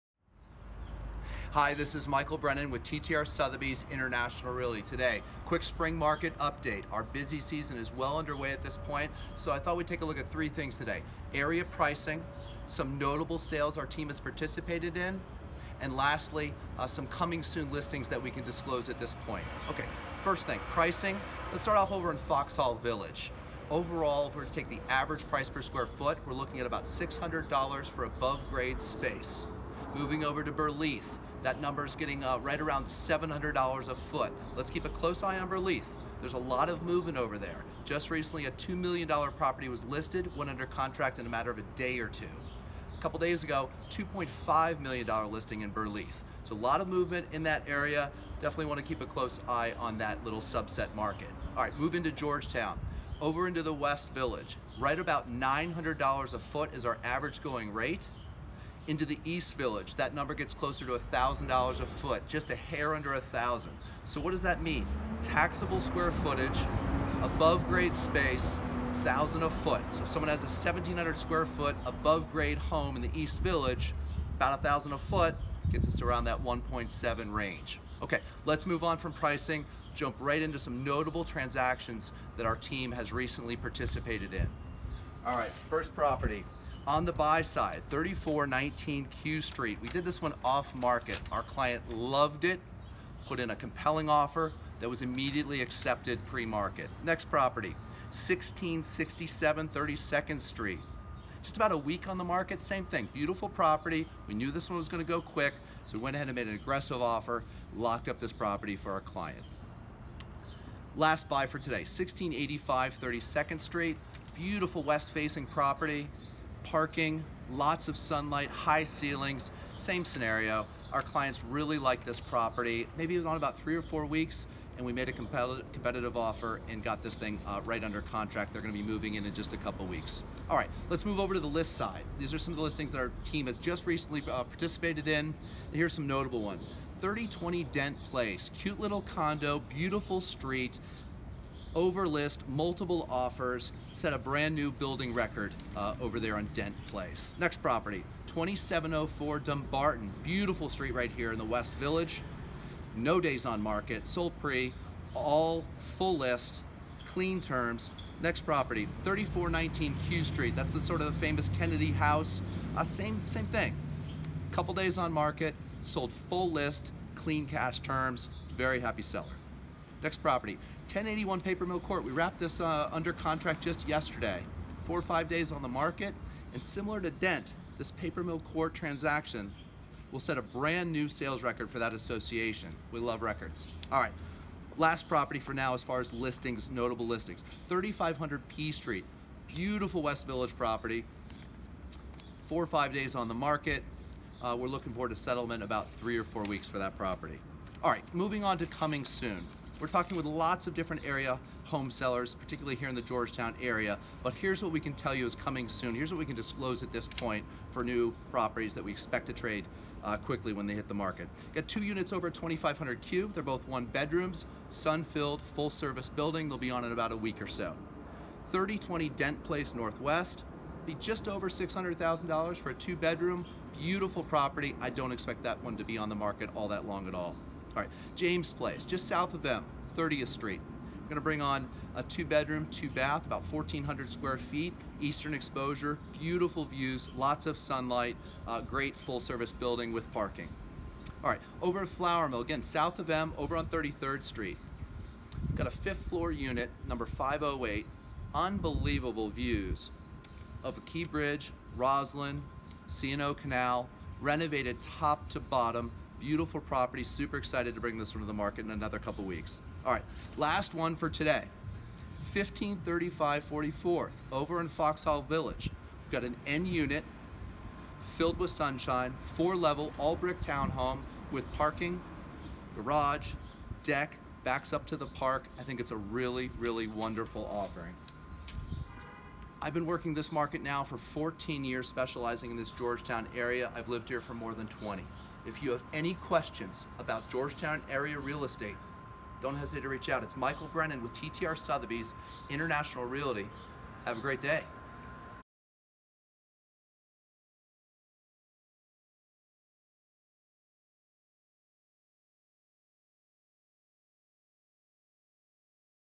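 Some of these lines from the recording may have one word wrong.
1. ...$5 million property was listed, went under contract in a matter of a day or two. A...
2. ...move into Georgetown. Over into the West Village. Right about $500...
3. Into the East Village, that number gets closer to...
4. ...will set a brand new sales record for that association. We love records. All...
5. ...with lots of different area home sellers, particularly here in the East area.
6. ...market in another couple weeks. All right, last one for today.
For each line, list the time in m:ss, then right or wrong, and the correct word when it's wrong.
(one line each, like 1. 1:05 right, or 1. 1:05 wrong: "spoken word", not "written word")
1. 0:38 wrong: "2", not "5"
2. 0:51 wrong: "900", not "500"
3. 0:58 right
4. 3:00 right
5. 3:20 wrong: "Georgetown", not "East"
6. 4:18 right.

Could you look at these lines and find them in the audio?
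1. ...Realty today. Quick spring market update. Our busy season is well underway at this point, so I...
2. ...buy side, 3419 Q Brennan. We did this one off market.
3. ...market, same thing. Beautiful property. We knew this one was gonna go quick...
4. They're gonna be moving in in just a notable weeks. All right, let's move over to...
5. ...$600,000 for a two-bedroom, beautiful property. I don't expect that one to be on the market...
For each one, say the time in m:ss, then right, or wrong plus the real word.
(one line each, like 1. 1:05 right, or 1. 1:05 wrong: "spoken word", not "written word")
1. 0:04 right
2. 1:27 wrong: "Street", not "Brennan"
3. 1:42 right
4. 2:08 wrong: "couple", not "notable"
5. 3:41 right.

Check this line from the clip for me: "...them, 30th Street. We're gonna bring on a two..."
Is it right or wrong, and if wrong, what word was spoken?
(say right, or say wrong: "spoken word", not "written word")
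right.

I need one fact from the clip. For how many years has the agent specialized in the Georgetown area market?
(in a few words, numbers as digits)
14.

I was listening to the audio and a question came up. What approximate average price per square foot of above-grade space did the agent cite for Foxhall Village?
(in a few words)
$600.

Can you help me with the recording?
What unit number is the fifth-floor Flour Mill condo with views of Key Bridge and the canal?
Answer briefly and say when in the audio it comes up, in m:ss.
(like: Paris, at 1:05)
508, at 4:07.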